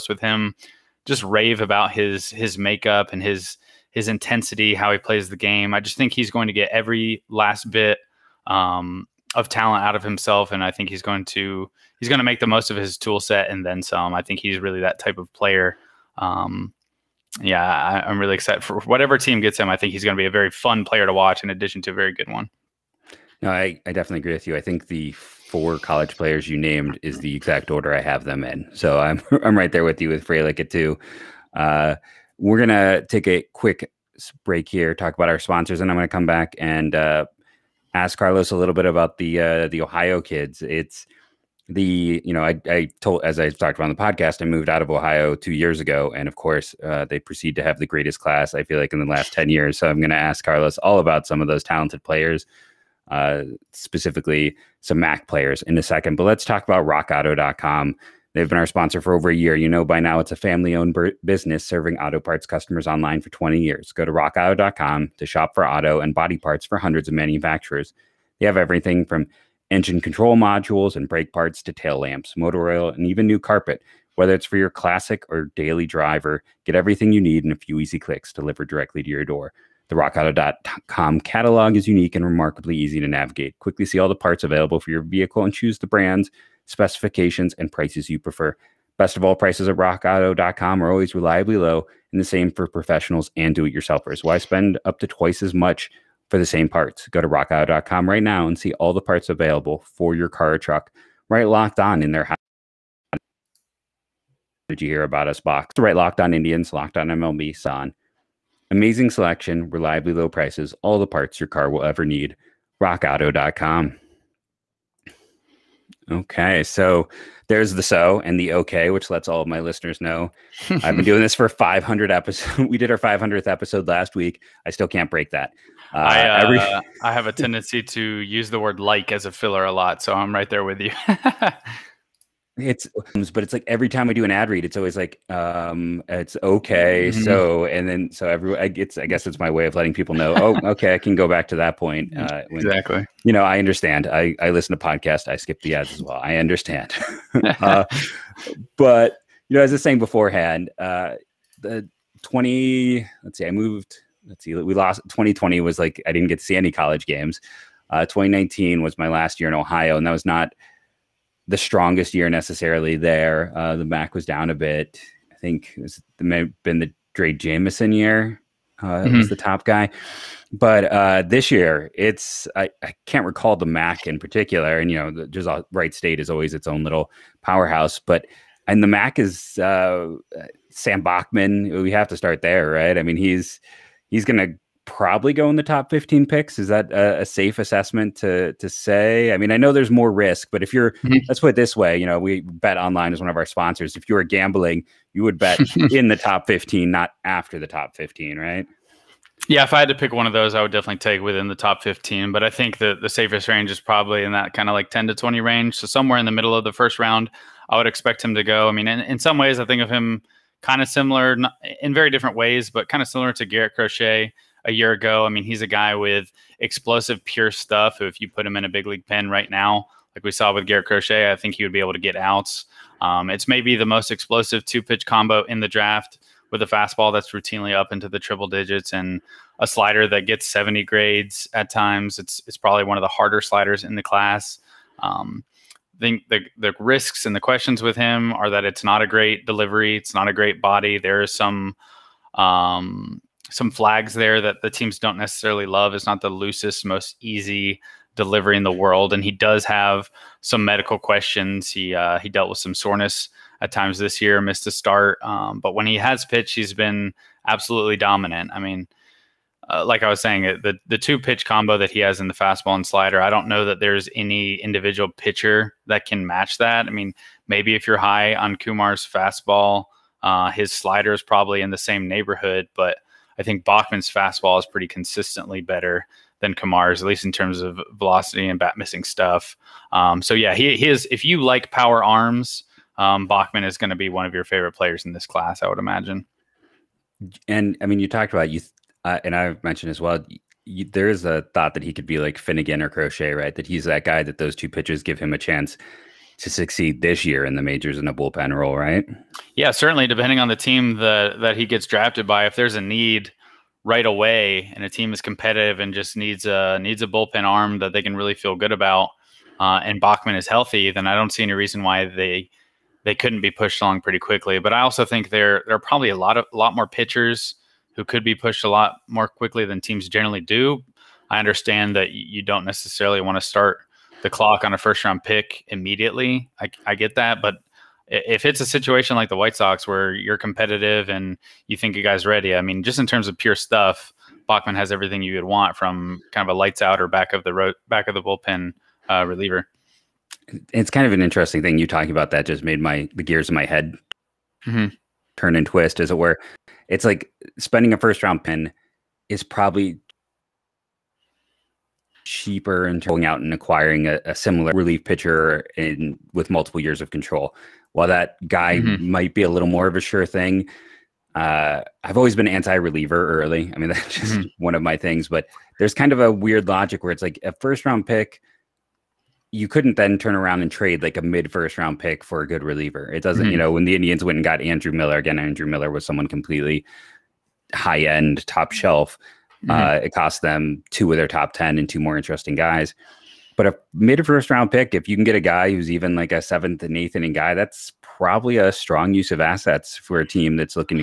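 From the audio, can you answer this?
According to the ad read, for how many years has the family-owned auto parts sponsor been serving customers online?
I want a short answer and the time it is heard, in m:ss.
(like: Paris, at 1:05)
20, at 1:03.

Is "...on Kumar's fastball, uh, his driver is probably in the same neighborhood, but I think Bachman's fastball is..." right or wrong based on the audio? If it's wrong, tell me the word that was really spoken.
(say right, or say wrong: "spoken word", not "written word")
wrong: "slider", not "driver".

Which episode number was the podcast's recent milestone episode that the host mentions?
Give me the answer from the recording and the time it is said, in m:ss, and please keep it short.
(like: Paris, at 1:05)
500, at 2:02.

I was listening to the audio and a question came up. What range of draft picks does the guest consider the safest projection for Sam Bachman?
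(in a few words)
10 to 20.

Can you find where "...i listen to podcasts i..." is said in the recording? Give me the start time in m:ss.
2:24.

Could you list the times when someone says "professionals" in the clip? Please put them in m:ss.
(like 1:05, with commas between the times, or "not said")
1:32.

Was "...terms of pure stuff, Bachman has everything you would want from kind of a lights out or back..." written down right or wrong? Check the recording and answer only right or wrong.
right.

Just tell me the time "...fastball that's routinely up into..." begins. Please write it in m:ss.
3:46.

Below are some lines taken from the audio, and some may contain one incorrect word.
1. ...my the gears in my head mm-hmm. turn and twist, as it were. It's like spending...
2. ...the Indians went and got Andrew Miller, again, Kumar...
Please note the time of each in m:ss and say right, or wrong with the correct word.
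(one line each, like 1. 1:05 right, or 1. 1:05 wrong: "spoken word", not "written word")
1. 5:42 right
2. 6:13 wrong: "Andrew", not "Kumar".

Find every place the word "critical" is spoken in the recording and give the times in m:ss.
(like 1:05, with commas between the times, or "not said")
not said.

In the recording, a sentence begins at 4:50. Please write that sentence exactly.
You, there is a thought that he could be like Finnegan or Crochet, right?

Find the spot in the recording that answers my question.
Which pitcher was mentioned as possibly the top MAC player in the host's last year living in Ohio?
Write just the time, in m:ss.
2:47.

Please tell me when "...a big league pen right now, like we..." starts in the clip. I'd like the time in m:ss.
3:38.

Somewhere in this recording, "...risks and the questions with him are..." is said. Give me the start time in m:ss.
3:56.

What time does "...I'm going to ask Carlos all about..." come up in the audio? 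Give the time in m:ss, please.
0:49.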